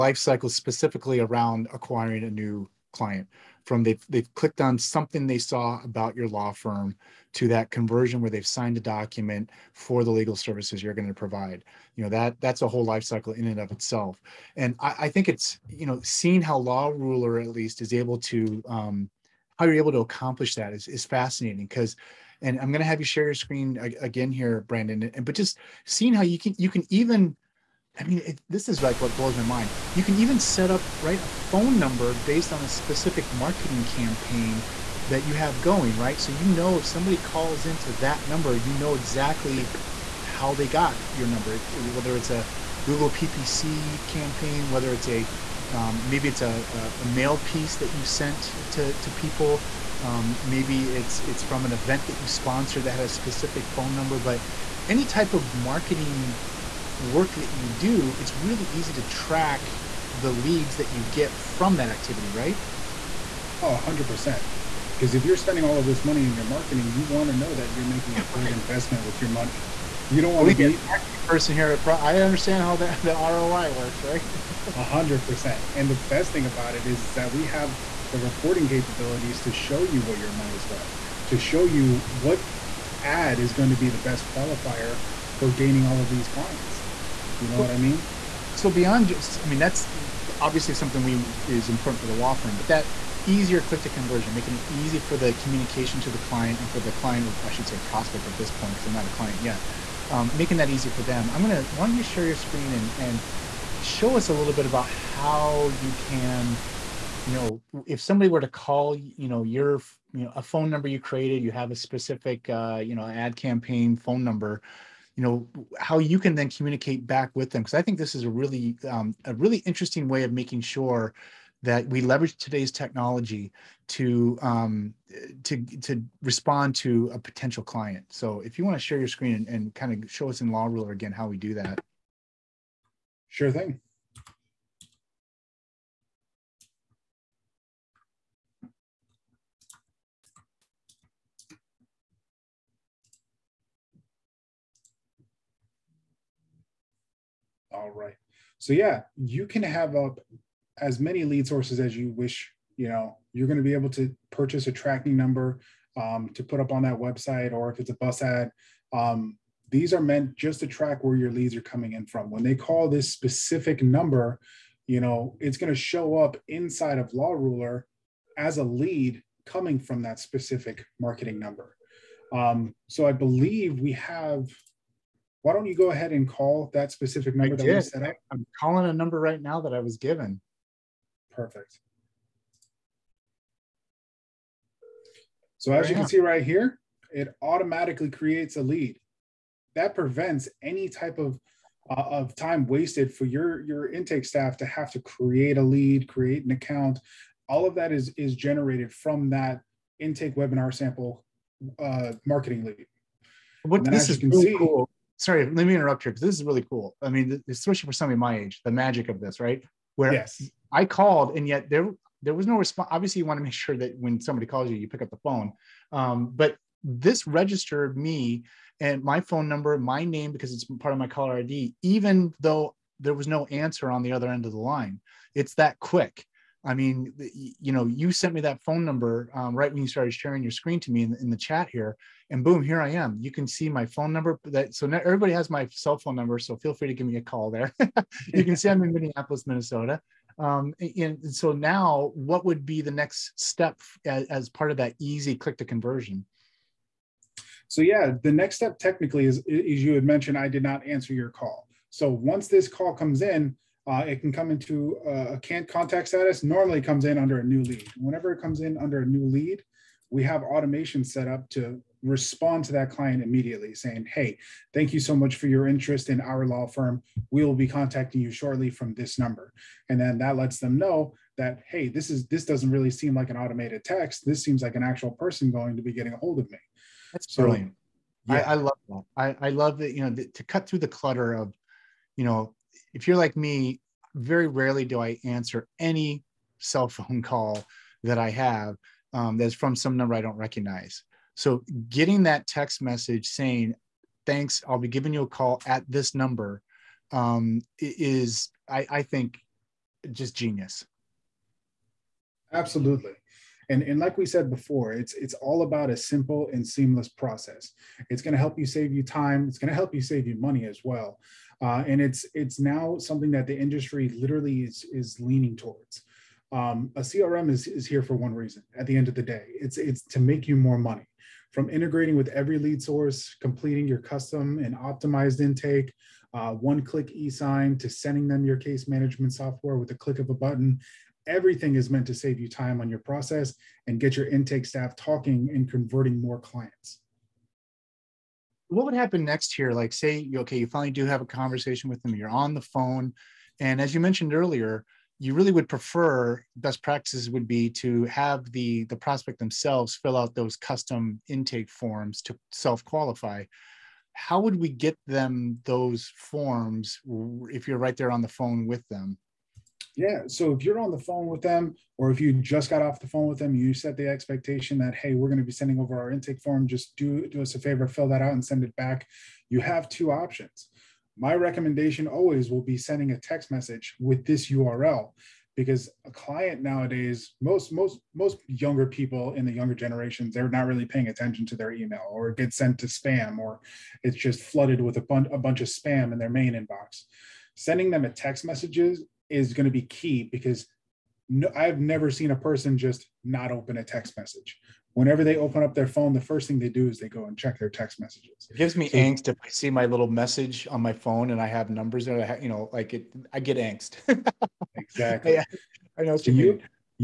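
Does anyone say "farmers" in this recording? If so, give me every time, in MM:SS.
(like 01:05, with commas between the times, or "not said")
not said.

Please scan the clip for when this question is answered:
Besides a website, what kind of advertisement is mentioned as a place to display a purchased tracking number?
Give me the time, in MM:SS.
02:37.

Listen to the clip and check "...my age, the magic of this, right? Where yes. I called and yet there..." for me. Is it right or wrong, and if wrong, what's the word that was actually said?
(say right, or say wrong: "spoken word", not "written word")
right.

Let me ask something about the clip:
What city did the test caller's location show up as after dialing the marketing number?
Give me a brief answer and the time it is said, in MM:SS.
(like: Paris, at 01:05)
Minneapolis, Minnesota, at 03:58.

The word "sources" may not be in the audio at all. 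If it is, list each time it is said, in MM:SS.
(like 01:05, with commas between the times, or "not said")
02:31, 05:22.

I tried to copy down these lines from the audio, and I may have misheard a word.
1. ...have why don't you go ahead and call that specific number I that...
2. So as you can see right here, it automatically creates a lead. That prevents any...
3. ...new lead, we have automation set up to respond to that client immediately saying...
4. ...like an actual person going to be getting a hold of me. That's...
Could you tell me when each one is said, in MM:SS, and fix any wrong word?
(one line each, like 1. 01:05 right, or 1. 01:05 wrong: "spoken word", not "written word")
1. 02:53 right
2. 03:05 right
3. 04:19 right
4. 04:34 right.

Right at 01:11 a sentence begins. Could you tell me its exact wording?
Pro- I understand how that the ROI works, right?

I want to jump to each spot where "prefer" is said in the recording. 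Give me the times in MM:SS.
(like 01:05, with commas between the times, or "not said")
05:45.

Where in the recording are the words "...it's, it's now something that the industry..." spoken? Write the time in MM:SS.
05:12.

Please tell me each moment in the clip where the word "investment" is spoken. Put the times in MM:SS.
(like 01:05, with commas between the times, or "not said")
01:08.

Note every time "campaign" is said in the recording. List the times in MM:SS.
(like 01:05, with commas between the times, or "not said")
00:33, 00:44, 01:53.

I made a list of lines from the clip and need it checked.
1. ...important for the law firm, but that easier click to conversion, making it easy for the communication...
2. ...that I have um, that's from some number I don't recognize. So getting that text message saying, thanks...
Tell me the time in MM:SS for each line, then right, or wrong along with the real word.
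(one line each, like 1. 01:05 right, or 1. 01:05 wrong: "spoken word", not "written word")
1. 01:31 right
2. 04:48 right.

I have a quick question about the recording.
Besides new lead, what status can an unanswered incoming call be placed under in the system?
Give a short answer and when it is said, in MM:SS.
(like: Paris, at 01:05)
can't contact, at 04:15.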